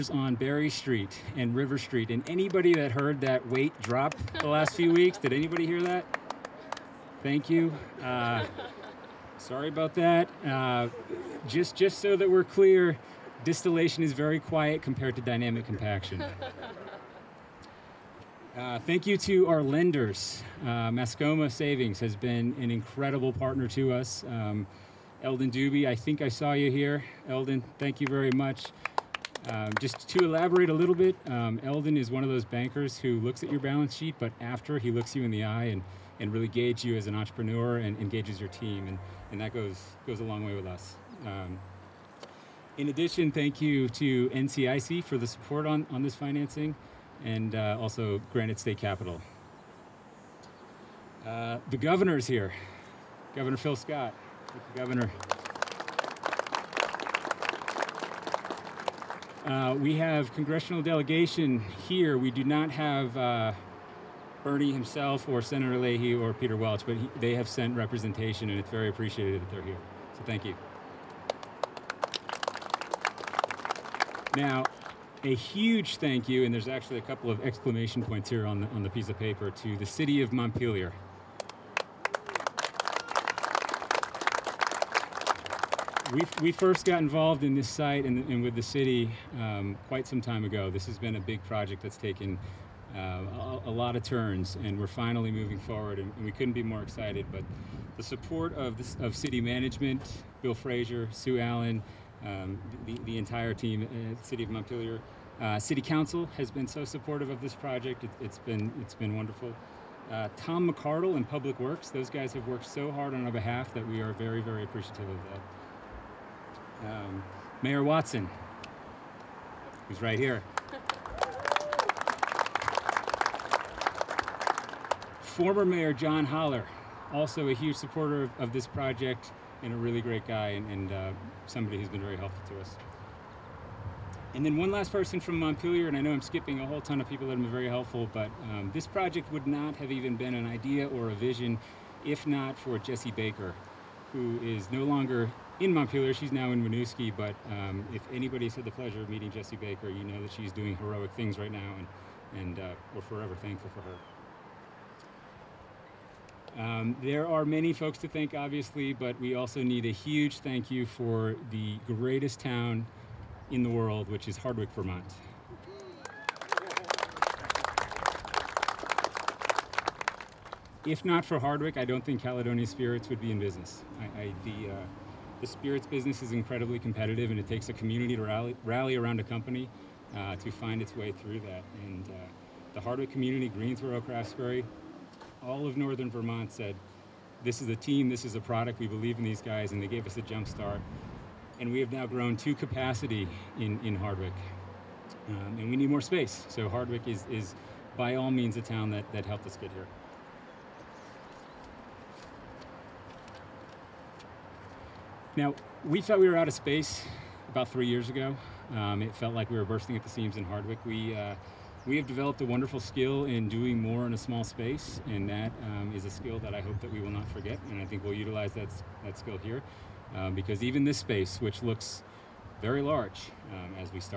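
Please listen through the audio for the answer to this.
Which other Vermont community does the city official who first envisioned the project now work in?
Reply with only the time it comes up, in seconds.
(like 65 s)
146 s.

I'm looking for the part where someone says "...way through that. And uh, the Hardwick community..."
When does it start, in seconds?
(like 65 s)
180 s.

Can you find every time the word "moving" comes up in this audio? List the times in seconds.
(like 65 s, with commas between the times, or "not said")
95 s.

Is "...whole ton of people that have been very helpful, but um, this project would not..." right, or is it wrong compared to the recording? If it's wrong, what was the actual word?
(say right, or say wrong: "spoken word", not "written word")
right.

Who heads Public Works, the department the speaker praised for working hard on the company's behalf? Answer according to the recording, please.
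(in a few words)
Tom McArdle.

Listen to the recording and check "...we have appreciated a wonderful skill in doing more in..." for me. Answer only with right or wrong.
wrong.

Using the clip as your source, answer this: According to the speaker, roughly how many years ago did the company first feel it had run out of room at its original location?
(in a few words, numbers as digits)
3 years.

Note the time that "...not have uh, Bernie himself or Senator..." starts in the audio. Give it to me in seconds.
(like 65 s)
62 s.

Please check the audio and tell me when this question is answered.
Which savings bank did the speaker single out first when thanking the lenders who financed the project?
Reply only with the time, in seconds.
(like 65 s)
20 s.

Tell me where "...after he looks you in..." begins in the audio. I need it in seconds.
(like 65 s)
34 s.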